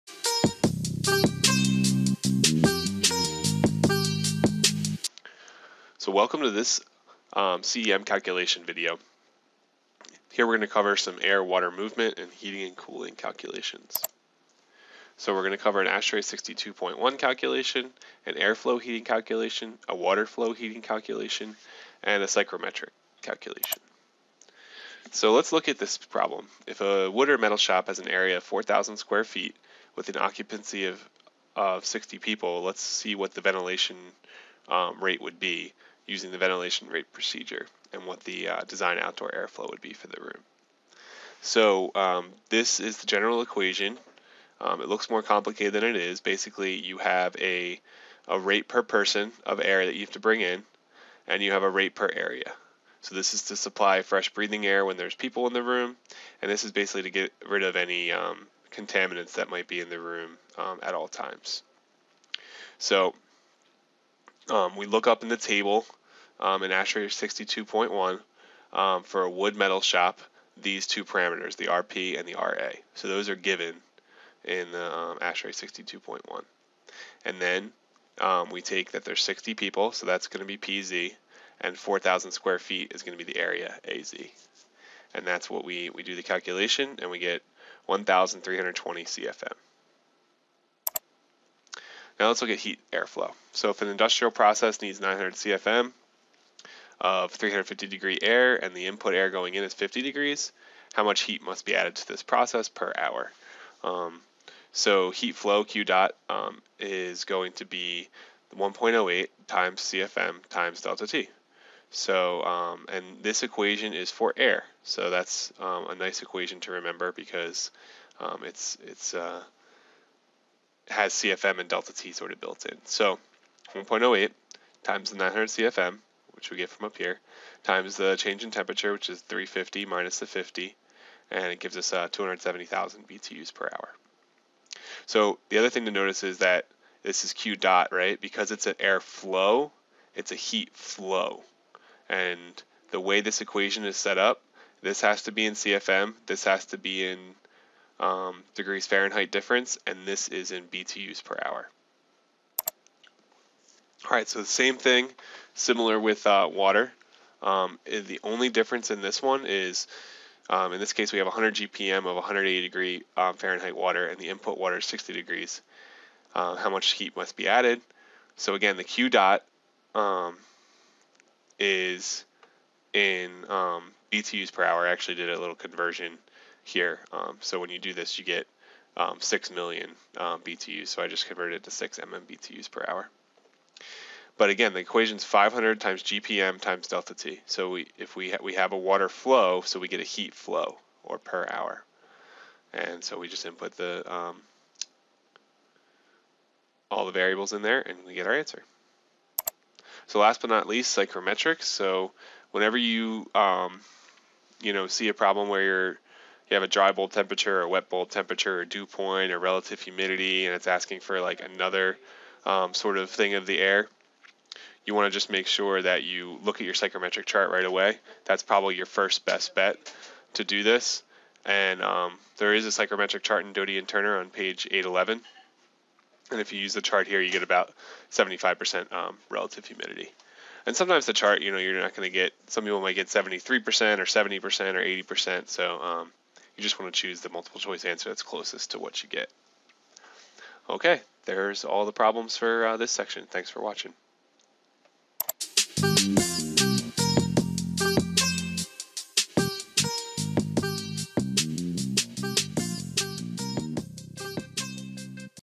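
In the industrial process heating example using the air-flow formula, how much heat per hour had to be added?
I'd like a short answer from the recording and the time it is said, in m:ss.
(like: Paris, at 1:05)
270,000 BTUs per hour, at 2:12.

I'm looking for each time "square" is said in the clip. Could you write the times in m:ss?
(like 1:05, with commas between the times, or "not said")
0:28, 1:22.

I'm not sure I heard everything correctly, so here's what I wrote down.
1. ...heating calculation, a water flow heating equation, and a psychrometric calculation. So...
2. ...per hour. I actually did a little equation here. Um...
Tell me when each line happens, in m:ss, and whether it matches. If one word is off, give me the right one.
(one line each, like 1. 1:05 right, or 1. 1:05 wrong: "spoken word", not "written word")
1. 0:18 wrong: "calculation", not "equation"
2. 2:54 wrong: "conversion", not "equation".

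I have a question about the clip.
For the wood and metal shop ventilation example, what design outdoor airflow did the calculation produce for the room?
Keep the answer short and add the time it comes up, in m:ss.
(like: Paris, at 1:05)
1,320 CFM, at 1:27.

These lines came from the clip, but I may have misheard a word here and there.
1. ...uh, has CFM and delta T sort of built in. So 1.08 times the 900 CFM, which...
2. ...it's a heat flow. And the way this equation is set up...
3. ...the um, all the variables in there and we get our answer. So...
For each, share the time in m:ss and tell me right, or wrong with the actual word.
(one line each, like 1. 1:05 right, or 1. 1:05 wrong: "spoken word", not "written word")
1. 1:59 right
2. 2:20 right
3. 3:13 right.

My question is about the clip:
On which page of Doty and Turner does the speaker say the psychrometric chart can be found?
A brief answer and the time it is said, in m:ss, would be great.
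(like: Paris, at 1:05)
811, at 3:44.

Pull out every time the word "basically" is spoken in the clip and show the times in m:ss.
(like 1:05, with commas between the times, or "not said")
0:46, 0:56.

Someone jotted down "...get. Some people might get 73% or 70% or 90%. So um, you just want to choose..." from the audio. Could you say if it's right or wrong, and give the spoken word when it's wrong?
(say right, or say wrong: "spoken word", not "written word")
wrong: "80", not "90".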